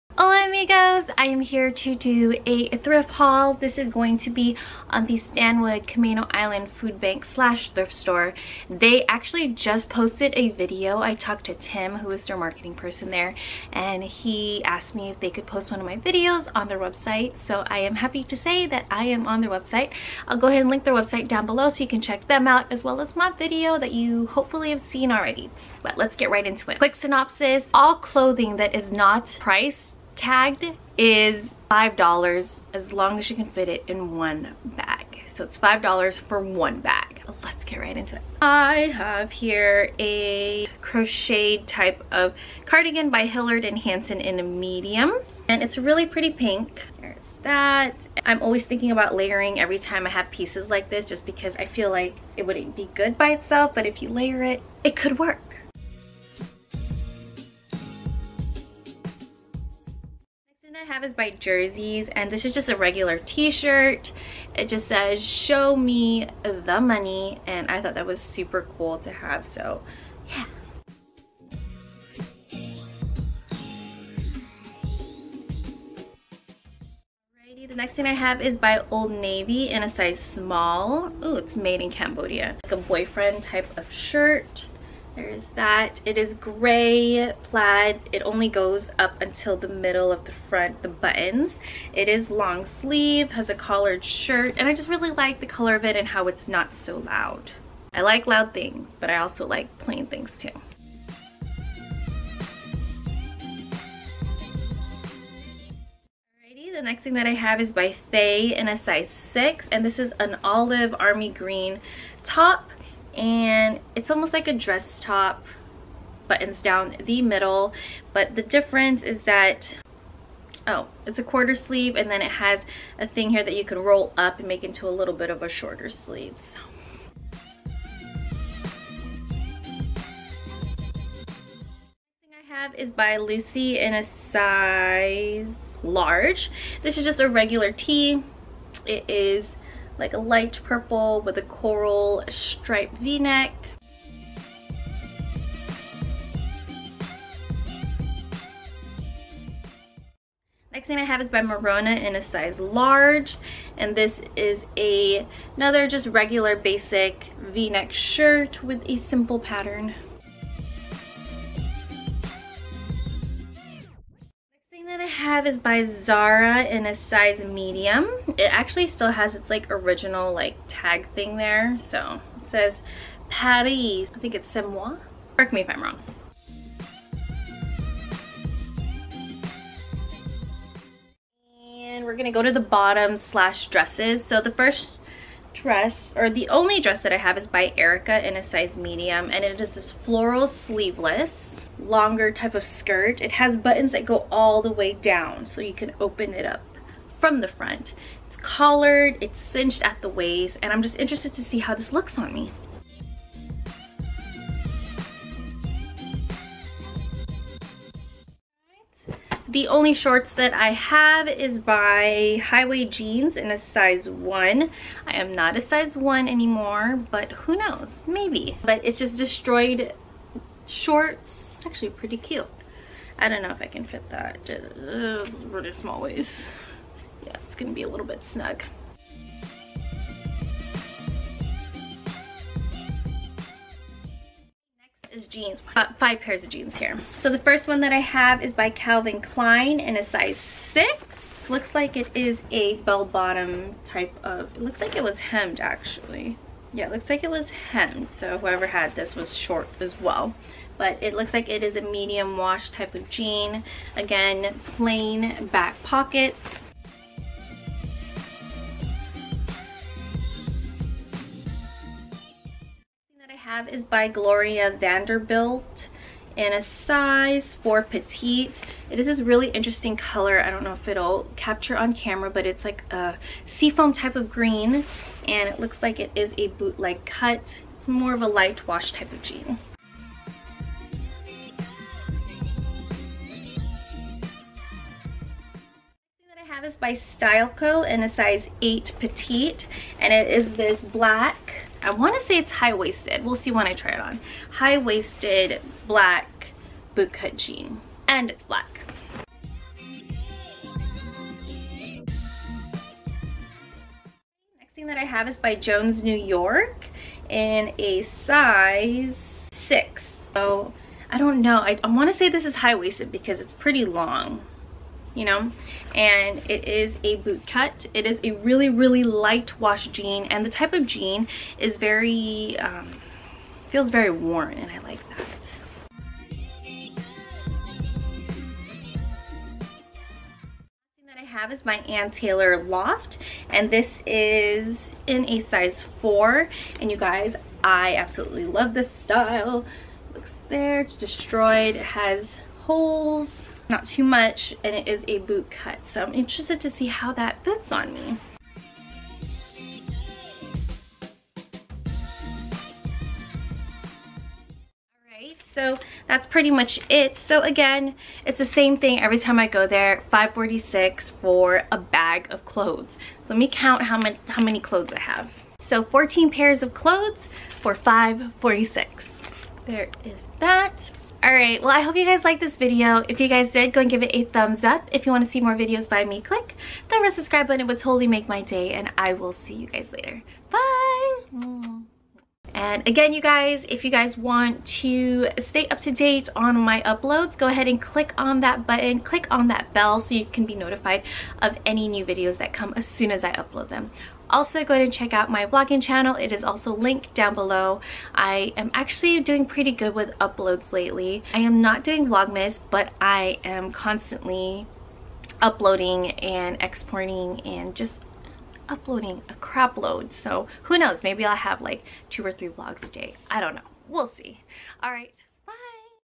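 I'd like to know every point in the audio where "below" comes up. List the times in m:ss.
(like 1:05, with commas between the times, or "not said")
0:21, 6:37.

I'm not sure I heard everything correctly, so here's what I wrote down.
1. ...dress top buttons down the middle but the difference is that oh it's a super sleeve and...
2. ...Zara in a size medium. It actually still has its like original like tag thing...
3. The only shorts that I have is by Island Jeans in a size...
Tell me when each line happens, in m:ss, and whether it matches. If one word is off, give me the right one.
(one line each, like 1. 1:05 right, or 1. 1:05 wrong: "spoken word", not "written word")
1. 1:54 wrong: "quarter", not "super"
2. 2:45 right
3. 3:29 wrong: "Highway", not "Island".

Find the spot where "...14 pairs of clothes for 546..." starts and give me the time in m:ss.
6:05.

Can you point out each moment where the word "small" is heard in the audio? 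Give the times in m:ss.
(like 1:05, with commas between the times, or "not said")
1:20, 3:45.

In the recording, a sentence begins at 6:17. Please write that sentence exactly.
It would totally make my day, and I will see you guys later.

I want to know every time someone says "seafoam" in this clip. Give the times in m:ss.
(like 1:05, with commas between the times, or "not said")
4:33.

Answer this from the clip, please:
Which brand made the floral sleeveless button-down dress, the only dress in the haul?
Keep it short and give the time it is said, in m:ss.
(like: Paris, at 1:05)
Erica, at 3:07.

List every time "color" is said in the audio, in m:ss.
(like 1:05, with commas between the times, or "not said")
1:35, 4:29.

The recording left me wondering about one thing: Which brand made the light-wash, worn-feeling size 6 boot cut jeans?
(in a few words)
Jones New York.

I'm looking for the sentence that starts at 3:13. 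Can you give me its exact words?
It has buttons that go all the way down so you can open it up from the front.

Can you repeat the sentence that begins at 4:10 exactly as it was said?
But it looks like it is a medium wash type of jean.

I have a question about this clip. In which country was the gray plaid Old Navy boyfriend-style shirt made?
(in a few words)
Cambodia.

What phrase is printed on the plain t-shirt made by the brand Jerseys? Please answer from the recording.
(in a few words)
Show me the money.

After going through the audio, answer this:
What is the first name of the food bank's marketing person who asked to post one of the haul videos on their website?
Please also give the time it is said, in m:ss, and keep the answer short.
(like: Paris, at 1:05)
Tim, at 0:11.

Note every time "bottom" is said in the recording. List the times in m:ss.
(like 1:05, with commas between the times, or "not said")
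3:02, 4:03.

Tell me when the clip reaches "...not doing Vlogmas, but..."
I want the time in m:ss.
6:41.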